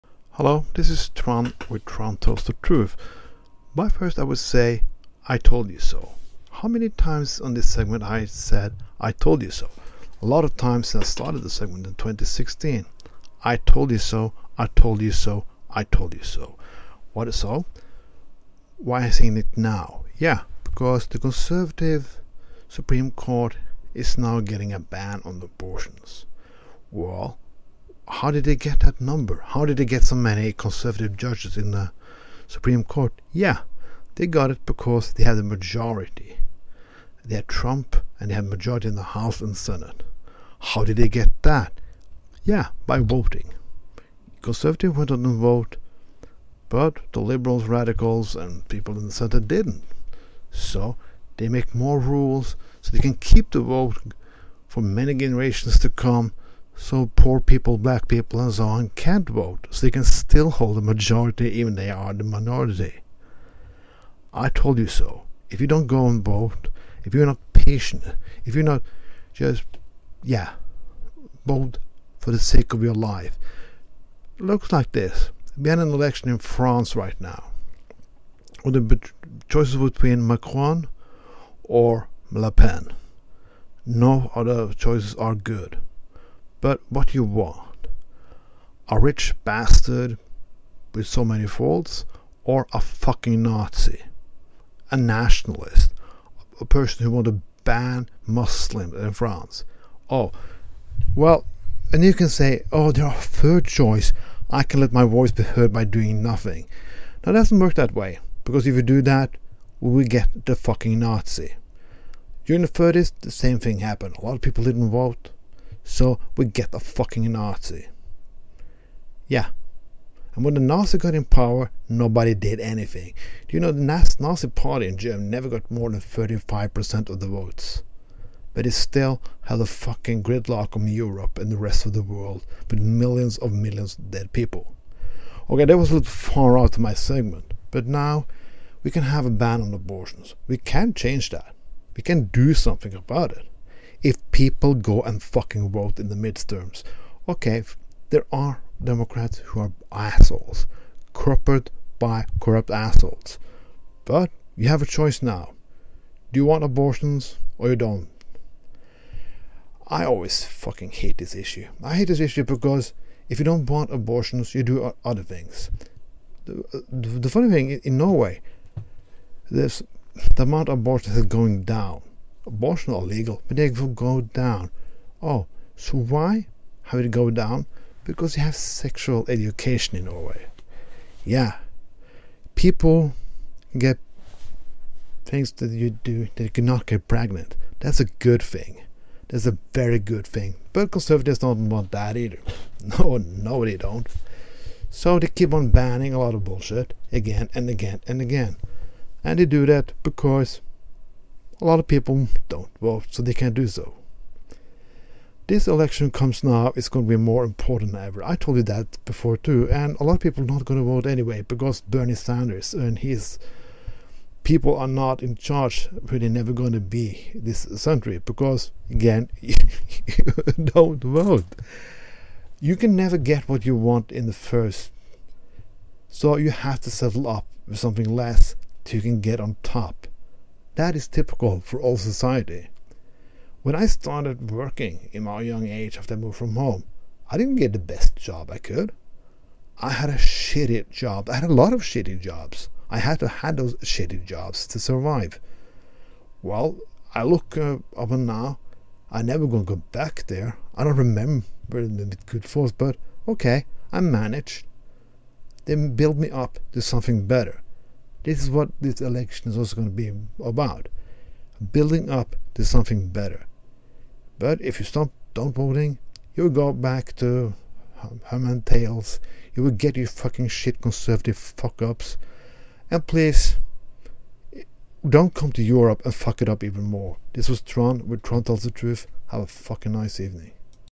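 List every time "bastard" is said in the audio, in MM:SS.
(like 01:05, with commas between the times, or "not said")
01:29.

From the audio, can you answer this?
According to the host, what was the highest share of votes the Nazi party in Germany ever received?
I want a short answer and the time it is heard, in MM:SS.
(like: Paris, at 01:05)
35%, at 02:05.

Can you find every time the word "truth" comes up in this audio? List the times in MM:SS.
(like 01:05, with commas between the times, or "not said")
00:02, 04:38.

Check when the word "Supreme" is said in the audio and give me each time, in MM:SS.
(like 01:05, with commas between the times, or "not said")
00:22, 00:32.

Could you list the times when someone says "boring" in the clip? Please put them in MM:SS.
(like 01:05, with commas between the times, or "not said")
not said.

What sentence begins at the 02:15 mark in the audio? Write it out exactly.
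Okay, that was a little far out of my segment, but now we can have a ban on abortions.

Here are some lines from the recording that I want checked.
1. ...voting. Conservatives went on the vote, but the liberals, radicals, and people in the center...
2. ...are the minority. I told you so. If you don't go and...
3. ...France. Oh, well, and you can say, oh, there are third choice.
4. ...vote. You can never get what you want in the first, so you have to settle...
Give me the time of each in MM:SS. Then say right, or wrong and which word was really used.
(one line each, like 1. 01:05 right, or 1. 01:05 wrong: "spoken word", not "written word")
1. 00:42 right
2. 01:01 right
3. 01:39 right
4. 03:41 right.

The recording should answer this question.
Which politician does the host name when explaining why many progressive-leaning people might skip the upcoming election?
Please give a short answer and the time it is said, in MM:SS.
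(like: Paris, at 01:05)
Bernie Sanders, at 03:31.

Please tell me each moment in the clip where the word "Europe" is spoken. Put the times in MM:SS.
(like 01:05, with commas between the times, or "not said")
02:10, 04:35.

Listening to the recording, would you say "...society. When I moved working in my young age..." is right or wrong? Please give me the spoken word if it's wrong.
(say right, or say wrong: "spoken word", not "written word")
wrong: "started", not "moved".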